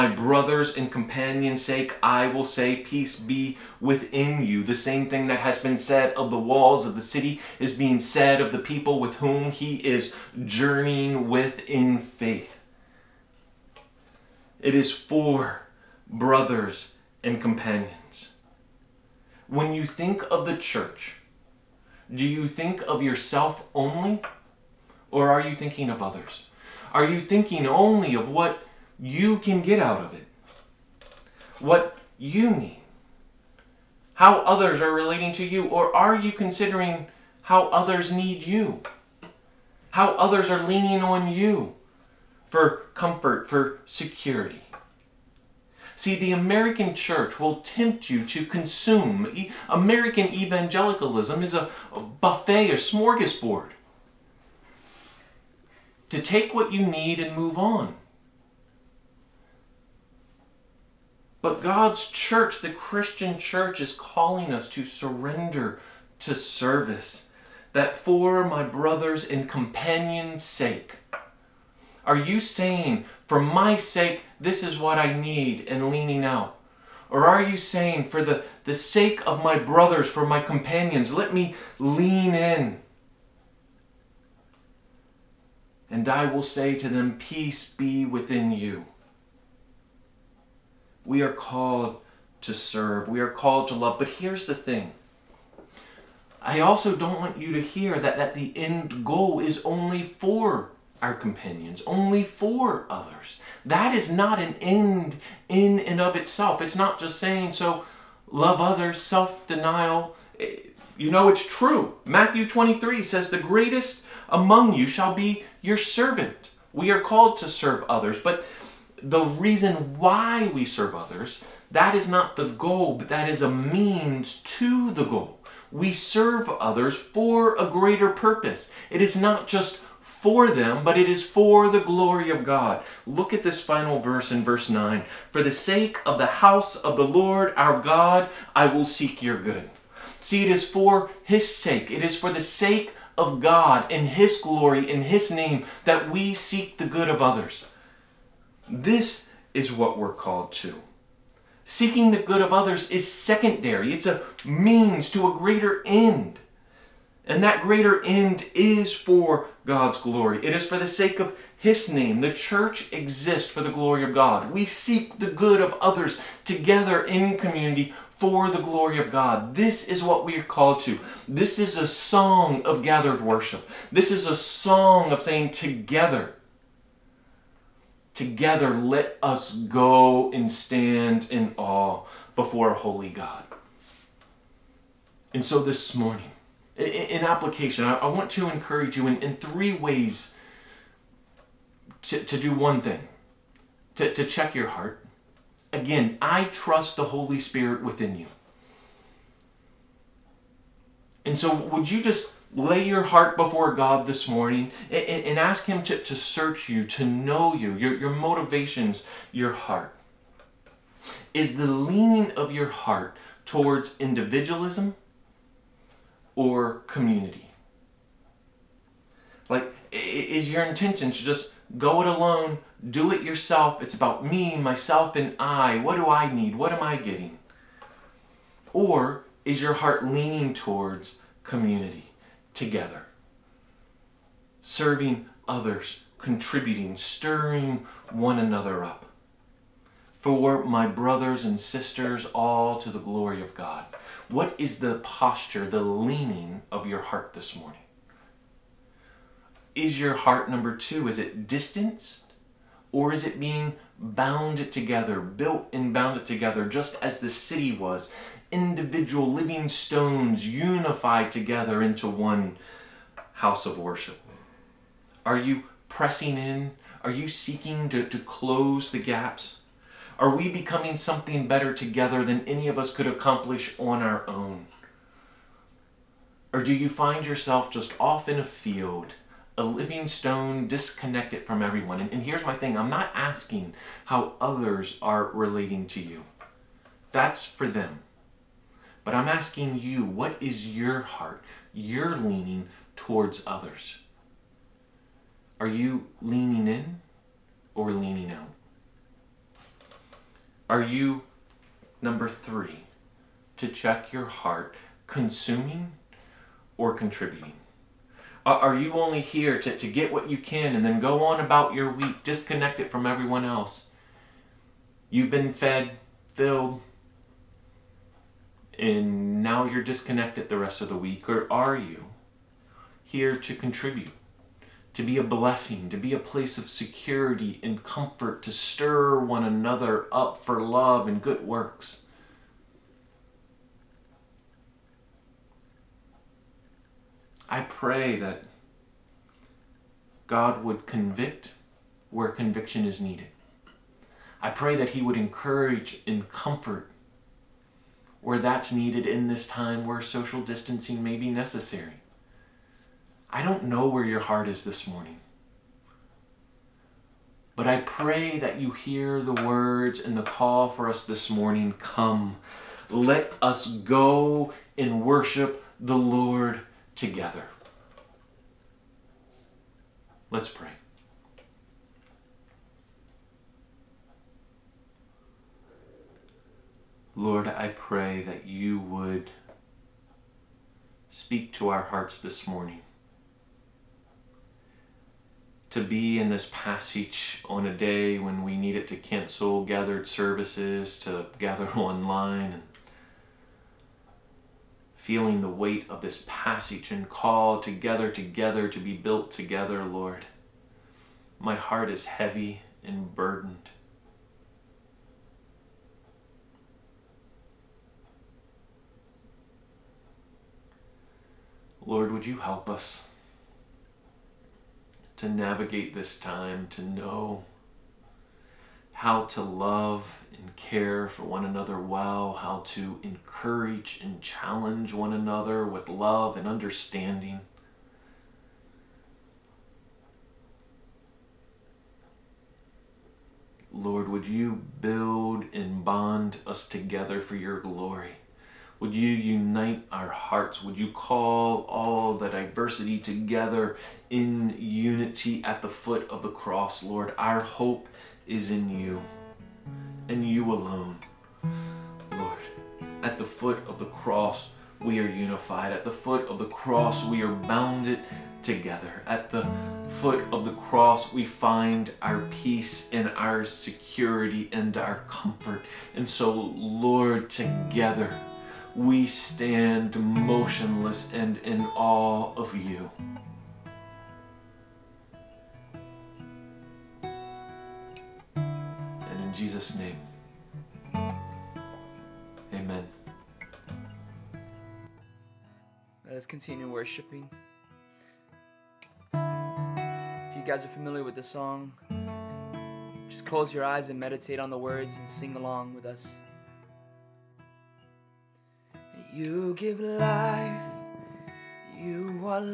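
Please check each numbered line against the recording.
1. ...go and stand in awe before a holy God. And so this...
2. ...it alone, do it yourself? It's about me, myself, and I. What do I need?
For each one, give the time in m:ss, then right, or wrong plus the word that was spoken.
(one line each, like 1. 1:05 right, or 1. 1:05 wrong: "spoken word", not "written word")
1. 2:59 right
2. 3:42 right.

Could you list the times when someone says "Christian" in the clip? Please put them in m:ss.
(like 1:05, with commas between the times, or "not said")
1:02.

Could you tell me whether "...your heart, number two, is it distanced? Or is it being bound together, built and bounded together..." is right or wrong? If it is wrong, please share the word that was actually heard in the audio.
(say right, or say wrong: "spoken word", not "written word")
right.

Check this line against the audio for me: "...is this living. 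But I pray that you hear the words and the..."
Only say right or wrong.
wrong.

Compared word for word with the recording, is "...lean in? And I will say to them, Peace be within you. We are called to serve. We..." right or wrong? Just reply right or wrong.
right.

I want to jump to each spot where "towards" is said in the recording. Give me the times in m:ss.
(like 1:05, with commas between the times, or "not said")
3:33, 3:50, 4:52.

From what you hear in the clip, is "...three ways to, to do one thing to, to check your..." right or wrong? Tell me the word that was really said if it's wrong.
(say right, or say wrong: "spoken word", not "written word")
right.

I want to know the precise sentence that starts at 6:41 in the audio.
My heart is heavy and burdened.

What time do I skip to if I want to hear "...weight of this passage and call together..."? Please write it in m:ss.
6:35.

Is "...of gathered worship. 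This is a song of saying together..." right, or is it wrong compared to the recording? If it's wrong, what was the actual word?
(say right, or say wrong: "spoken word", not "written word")
right.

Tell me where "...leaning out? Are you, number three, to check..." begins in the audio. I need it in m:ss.
4:57.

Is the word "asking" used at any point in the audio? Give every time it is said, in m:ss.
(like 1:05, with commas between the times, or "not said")
4:43, 4:49.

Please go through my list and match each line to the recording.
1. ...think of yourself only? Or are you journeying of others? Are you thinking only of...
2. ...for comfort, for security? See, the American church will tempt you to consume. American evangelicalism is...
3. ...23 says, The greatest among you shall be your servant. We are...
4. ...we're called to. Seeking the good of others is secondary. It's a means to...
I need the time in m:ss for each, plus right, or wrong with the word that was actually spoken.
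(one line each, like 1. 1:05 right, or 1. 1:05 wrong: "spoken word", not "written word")
1. 0:22 wrong: "thinking", not "journeying"
2. 0:42 right
3. 1:52 right
4. 2:29 right.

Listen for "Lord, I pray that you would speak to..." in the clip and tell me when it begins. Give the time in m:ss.
6:17.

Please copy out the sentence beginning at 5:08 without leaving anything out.
Are you only here to, to get what you can and then go on about your week, disconnect it from everyone else?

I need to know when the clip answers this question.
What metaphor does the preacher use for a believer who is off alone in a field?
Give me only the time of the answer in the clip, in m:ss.
4:39.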